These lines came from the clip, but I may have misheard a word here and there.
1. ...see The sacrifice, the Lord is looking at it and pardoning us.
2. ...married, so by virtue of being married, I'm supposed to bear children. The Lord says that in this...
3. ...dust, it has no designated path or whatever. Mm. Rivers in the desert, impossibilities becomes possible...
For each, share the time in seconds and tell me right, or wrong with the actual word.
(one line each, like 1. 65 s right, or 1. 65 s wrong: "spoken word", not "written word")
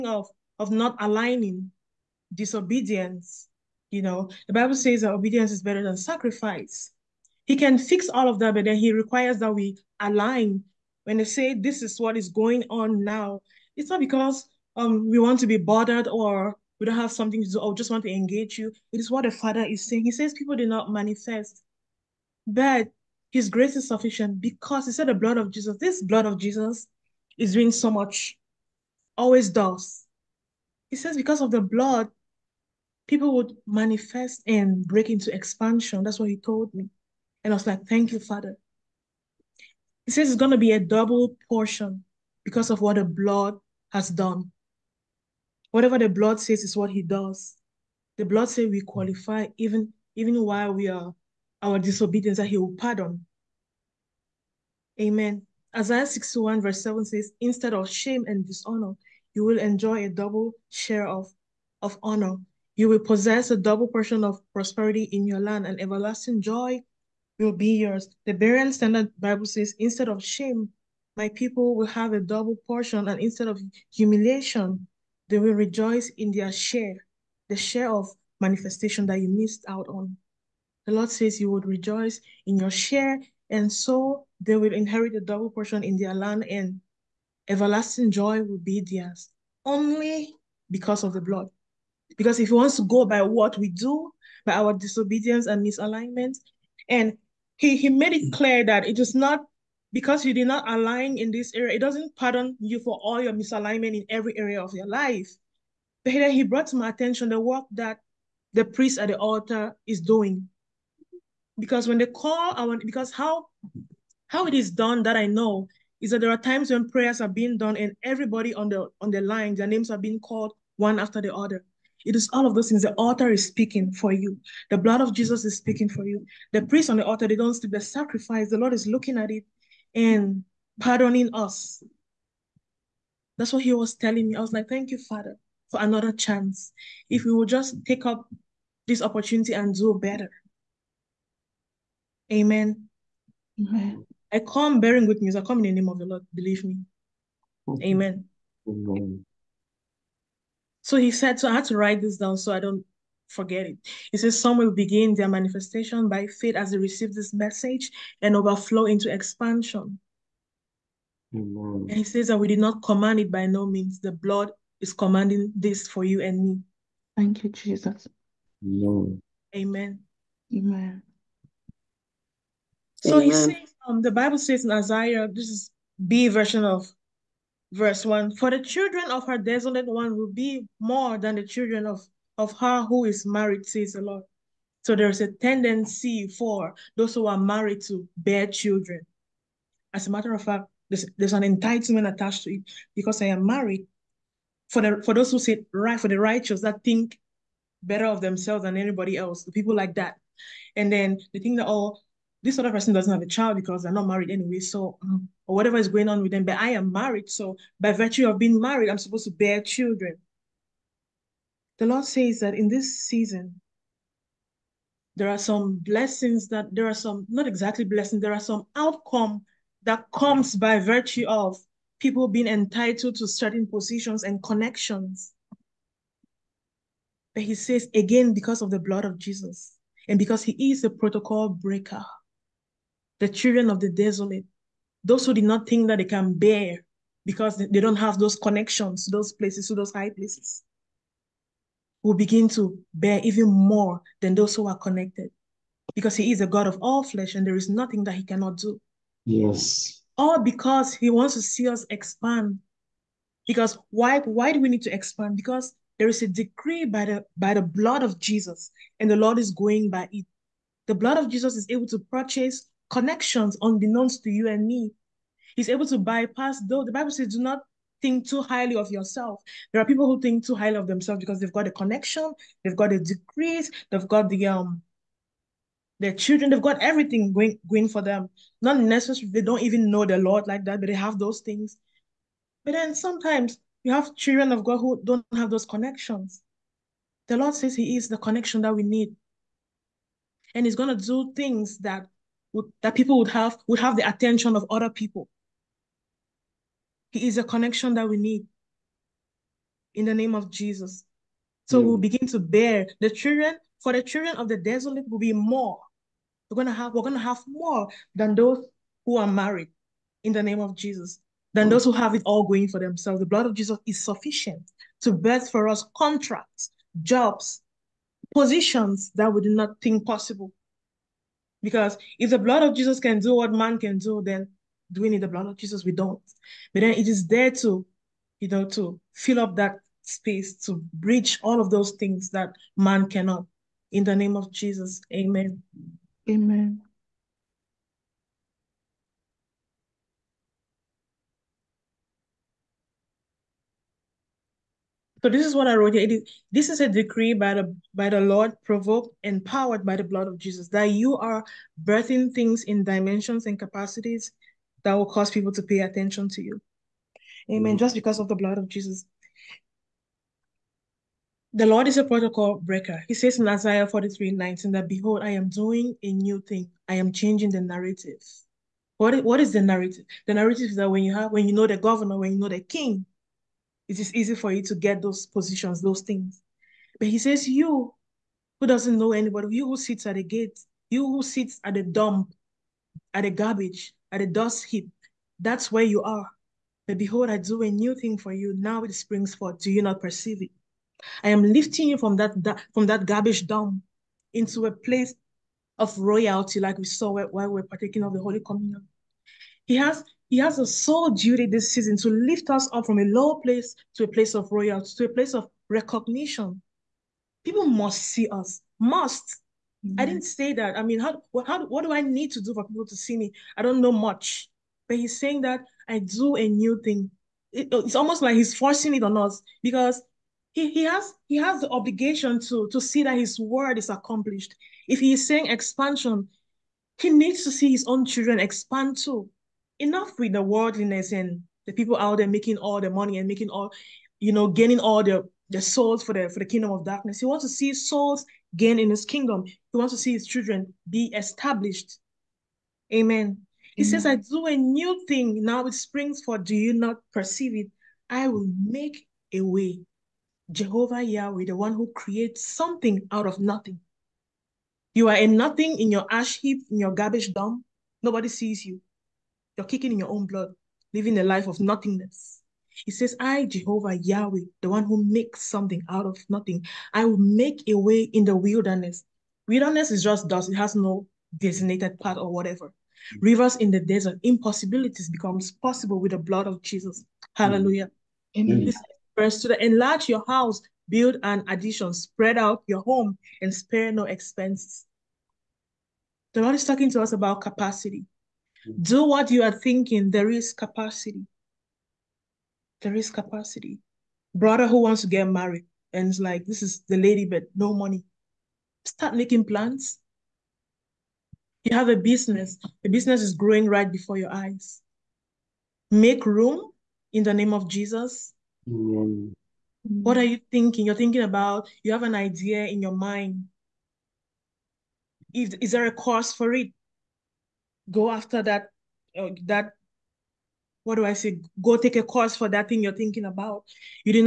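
1. 127 s right
2. 206 s right
3. 470 s right.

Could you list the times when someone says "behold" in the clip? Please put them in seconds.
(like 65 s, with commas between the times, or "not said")
364 s, 386 s.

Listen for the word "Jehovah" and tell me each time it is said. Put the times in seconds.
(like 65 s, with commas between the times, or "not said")
450 s, 463 s.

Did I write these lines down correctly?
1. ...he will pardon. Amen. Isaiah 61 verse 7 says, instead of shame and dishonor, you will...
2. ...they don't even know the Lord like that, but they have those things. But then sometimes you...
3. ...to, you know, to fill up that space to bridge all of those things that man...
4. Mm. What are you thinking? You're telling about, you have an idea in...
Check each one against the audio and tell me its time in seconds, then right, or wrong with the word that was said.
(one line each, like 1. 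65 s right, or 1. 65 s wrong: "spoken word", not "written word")
1. 52 s right
2. 279 s right
3. 327 s right
4. 508 s wrong: "thinking", not "telling".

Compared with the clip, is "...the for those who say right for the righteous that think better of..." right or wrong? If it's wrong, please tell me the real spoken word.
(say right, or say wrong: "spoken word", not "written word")
right.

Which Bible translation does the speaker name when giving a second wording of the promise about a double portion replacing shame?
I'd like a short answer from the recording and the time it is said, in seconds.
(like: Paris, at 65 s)
Berean Standard Bible, at 68 s.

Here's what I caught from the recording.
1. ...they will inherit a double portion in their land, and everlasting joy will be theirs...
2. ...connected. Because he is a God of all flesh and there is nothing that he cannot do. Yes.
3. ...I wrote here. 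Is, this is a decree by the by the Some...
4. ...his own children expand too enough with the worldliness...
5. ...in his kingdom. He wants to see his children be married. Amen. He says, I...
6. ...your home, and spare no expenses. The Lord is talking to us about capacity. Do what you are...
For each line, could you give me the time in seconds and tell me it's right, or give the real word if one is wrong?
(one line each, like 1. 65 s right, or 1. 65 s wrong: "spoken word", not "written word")
1. 84 s right
2. 244 s right
3. 345 s wrong: "Lord", not "Some"
4. 427 s right
5. 438 s wrong: "established", not "married"
6. 482 s right.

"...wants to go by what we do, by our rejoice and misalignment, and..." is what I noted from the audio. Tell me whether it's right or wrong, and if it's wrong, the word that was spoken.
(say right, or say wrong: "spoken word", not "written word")
wrong: "disobedience", not "rejoice".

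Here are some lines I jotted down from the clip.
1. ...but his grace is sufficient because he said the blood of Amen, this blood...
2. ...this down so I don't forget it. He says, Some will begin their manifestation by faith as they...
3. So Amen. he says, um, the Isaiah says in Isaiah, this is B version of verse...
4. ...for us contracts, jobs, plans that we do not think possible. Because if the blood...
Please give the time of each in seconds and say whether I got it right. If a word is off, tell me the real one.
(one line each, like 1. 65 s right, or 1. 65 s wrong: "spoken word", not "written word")
1. 22 s wrong: "Jesus", not "Amen"
2. 152 s right
3. 173 s wrong: "Bible", not "Isaiah"
4. 315 s wrong: "positions", not "plans".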